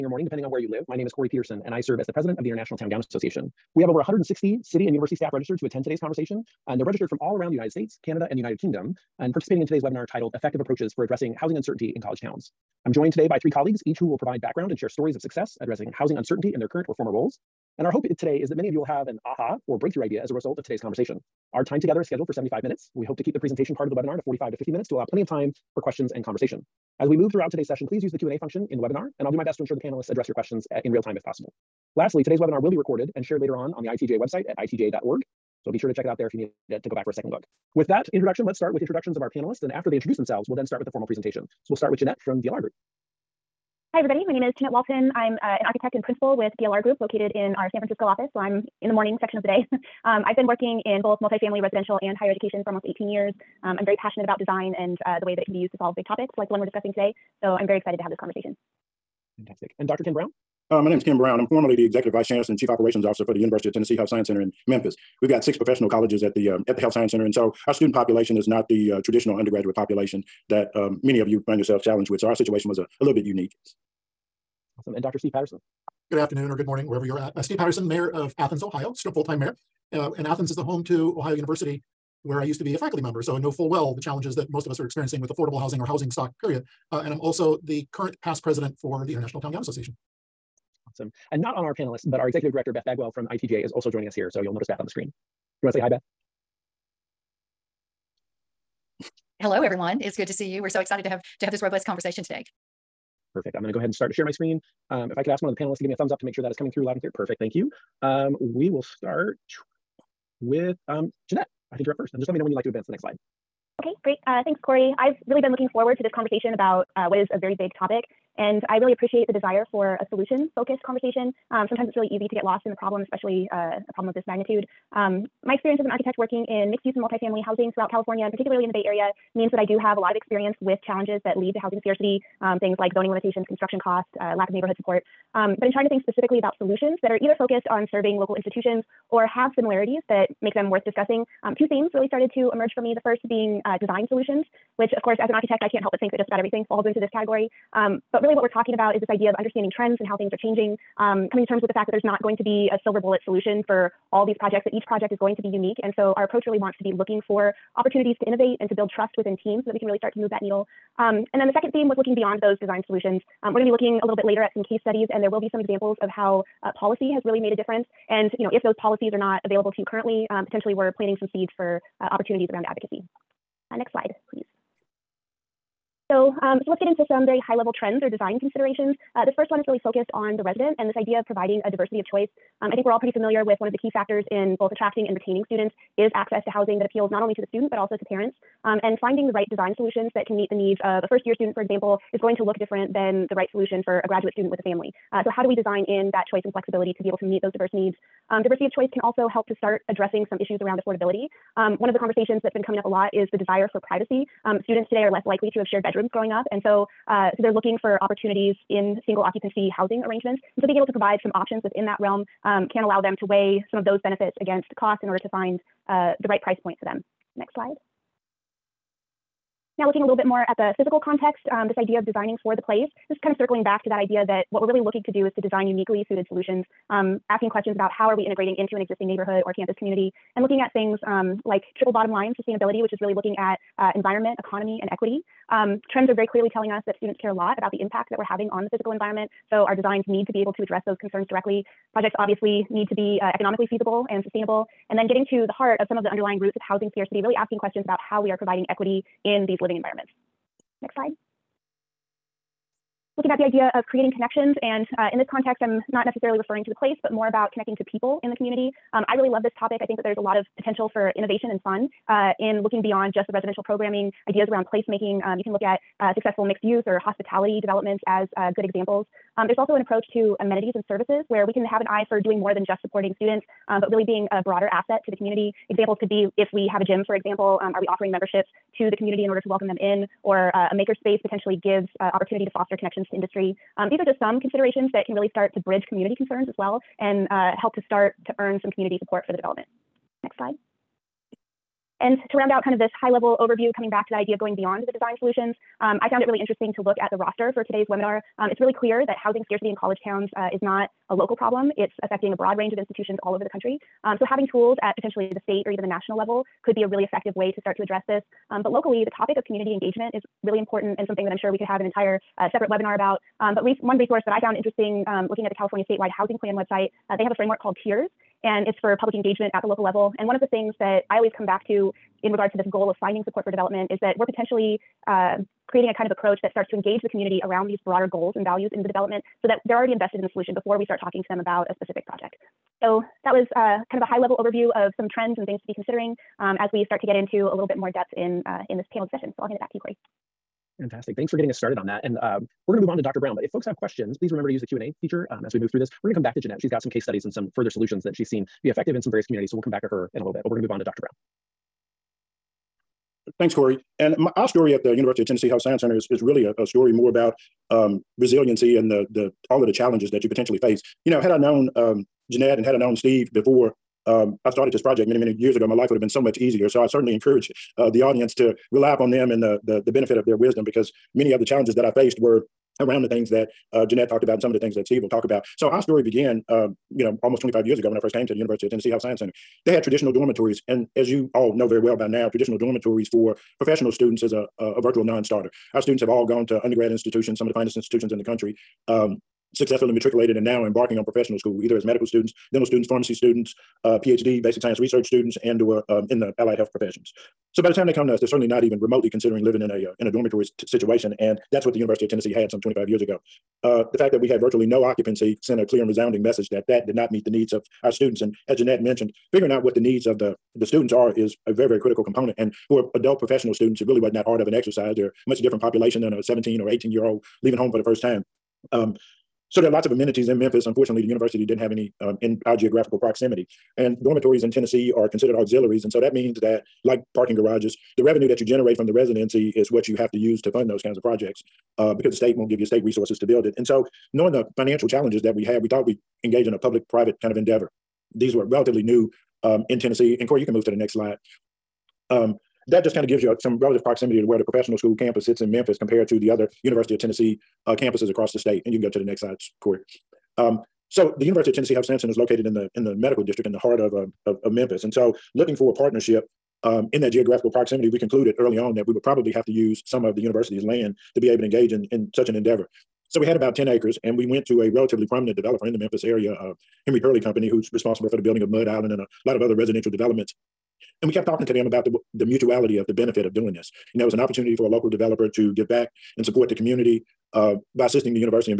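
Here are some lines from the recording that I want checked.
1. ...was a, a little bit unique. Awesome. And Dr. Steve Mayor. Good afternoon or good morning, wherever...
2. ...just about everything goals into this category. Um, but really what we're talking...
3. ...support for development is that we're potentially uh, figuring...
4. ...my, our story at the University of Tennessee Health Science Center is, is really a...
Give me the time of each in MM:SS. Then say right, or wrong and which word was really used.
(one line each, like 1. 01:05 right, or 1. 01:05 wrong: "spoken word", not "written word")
1. 01:12 wrong: "Patterson", not "Mayor"
2. 02:26 wrong: "falls", not "goals"
3. 05:23 wrong: "creating", not "figuring"
4. 05:54 right.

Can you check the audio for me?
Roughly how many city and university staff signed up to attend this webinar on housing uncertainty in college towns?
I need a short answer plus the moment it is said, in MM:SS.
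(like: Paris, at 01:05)
160, at 00:03.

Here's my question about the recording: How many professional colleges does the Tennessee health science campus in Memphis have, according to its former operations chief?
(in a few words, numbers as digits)
6.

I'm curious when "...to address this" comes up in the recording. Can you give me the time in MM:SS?
05:07.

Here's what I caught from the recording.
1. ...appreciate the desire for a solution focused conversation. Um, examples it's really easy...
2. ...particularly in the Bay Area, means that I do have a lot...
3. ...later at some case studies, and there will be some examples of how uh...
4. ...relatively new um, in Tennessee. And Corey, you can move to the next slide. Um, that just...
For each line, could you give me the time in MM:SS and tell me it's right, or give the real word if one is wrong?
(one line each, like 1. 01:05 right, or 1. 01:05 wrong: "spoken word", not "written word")
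1. 01:58 wrong: "sometimes", not "examples"
2. 02:08 right
3. 02:44 right
4. 07:18 right.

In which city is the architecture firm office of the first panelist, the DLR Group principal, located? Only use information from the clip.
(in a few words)
San Francisco.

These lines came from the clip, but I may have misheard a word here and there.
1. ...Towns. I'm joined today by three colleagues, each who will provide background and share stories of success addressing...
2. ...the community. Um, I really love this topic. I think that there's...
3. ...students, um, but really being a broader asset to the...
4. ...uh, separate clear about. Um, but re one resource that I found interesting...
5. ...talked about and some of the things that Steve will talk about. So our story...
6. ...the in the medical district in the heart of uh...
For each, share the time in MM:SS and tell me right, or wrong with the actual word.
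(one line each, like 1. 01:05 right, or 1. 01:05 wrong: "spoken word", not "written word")
1. 00:12 right
2. 04:18 right
3. 04:33 right
4. 05:12 wrong: "webinar", not "clear"
5. 06:14 right
6. 07:32 right.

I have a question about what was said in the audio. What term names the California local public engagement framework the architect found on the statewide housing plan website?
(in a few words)
tiers.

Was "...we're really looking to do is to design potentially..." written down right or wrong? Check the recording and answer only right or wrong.
wrong.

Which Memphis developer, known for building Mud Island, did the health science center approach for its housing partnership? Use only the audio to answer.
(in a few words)
Henry Turley Company.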